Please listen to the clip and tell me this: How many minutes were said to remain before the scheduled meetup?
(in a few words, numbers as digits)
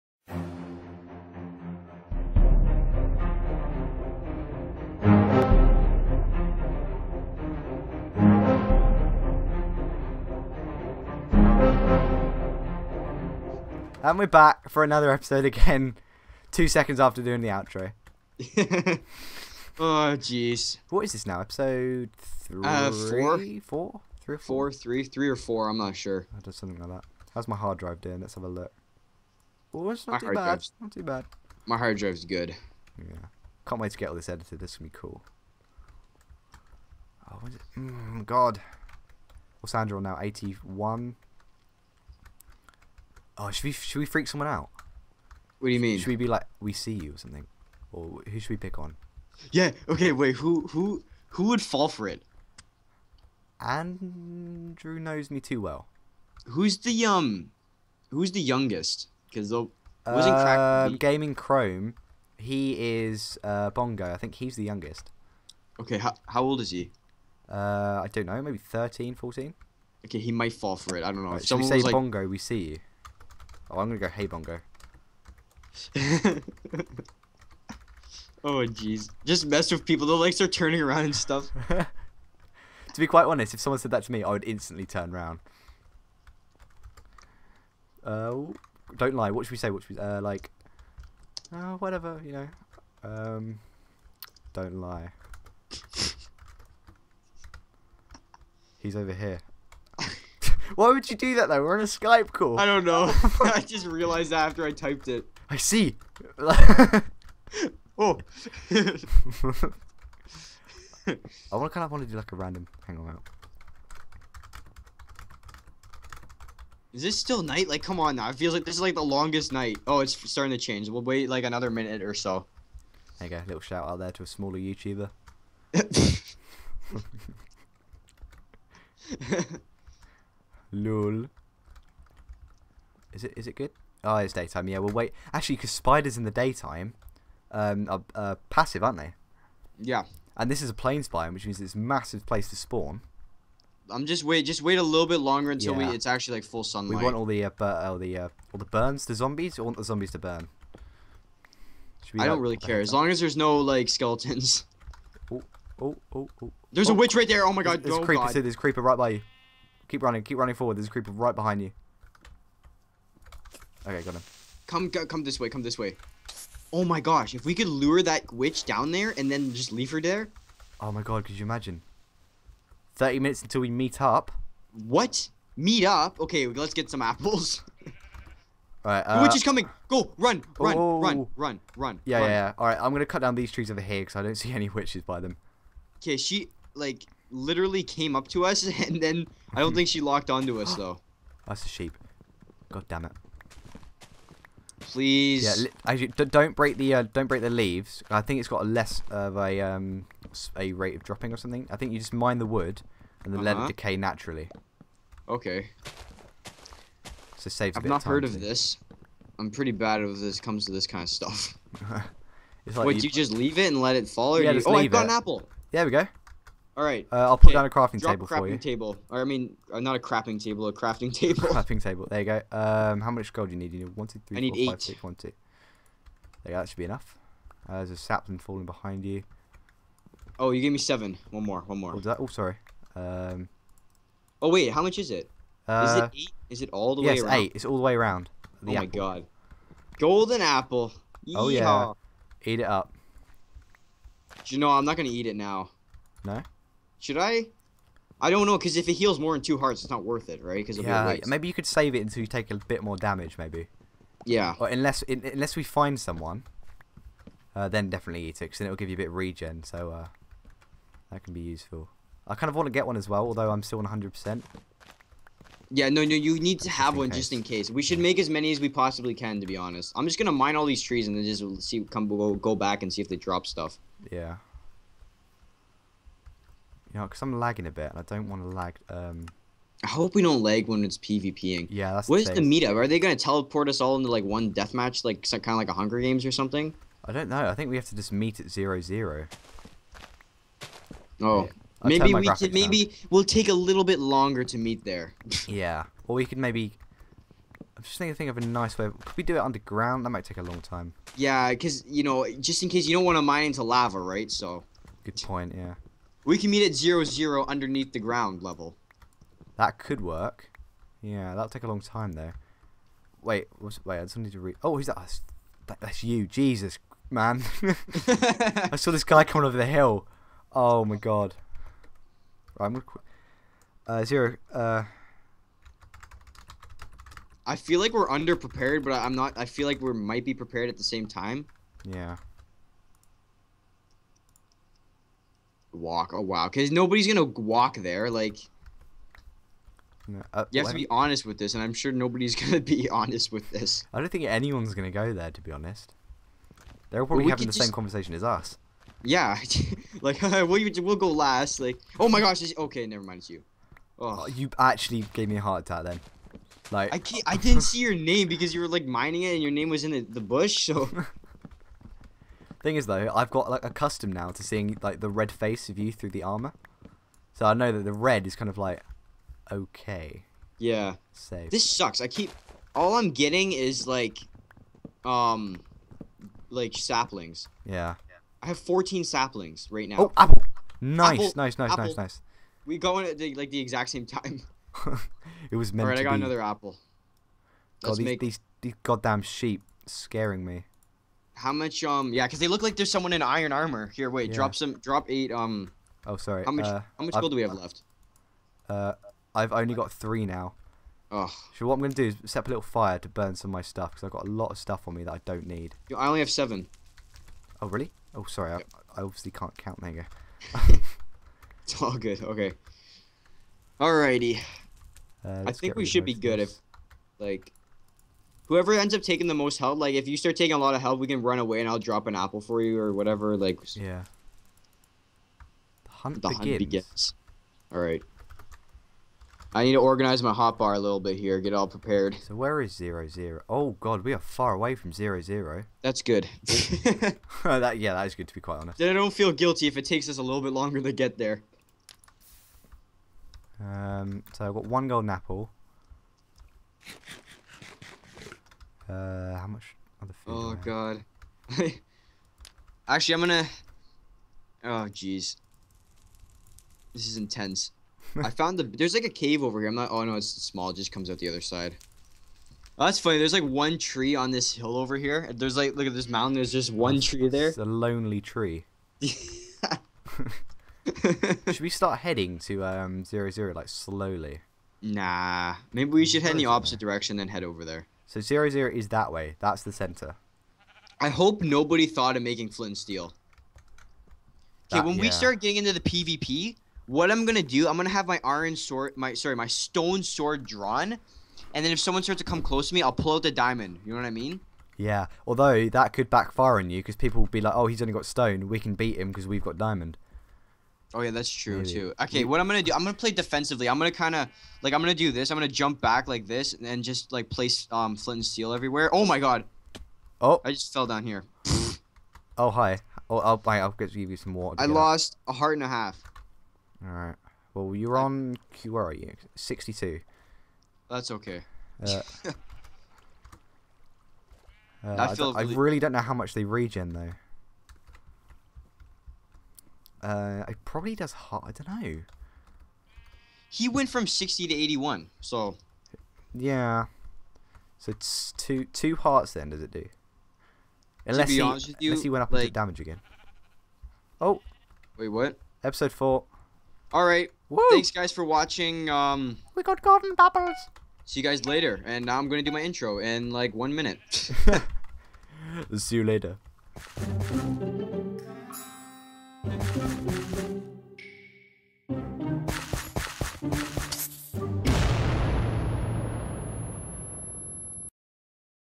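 30.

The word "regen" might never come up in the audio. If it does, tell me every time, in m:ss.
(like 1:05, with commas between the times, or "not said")
4:19, 8:46.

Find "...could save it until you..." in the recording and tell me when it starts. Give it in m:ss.
4:11.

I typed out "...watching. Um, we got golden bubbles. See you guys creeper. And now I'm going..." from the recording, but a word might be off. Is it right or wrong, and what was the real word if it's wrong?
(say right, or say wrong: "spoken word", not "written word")
wrong: "later", not "creeper".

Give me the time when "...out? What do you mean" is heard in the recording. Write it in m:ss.
0:44.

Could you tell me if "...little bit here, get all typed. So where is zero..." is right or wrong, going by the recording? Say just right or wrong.
wrong.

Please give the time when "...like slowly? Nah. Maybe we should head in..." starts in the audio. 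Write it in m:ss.
7:53.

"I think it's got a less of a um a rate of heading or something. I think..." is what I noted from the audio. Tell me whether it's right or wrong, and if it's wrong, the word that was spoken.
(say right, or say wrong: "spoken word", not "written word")
wrong: "dropping", not "heading".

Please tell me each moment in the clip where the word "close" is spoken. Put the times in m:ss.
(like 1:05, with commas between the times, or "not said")
8:12.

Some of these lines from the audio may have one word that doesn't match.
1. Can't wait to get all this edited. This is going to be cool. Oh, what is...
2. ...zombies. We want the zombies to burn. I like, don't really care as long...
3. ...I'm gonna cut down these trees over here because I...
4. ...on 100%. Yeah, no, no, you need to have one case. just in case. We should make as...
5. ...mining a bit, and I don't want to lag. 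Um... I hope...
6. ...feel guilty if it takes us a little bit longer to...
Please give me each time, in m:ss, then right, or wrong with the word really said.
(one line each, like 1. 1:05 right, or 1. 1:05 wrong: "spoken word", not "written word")
1. 0:33 right
2. 2:29 right
3. 3:02 right
4. 4:23 right
5. 4:37 wrong: "lagging", not "mining"
6. 7:19 right.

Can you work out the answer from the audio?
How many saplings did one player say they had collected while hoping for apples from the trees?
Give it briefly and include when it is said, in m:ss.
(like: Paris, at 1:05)
14, at 6:18.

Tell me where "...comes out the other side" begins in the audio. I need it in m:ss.
7:40.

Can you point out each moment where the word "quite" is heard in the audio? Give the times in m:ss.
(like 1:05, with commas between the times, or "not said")
1:23, 7:18.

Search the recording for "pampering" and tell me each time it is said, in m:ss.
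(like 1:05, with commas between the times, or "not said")
not said.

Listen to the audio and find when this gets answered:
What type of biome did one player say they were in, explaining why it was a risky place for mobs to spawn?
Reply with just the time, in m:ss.
2:20.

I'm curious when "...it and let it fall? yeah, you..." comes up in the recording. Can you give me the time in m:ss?
3:33.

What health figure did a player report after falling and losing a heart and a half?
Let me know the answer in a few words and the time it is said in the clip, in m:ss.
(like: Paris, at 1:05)
62, at 8:39.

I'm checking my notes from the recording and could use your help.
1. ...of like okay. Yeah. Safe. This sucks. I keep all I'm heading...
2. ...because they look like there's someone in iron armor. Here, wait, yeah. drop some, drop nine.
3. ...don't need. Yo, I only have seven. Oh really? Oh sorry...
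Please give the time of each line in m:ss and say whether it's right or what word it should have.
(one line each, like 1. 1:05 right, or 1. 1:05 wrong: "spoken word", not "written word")
1. 6:08 wrong: "getting", not "heading"
2. 6:32 wrong: "eight", not "nine"
3. 6:45 right.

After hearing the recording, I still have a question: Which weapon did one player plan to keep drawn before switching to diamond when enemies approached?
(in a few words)
Stone sword.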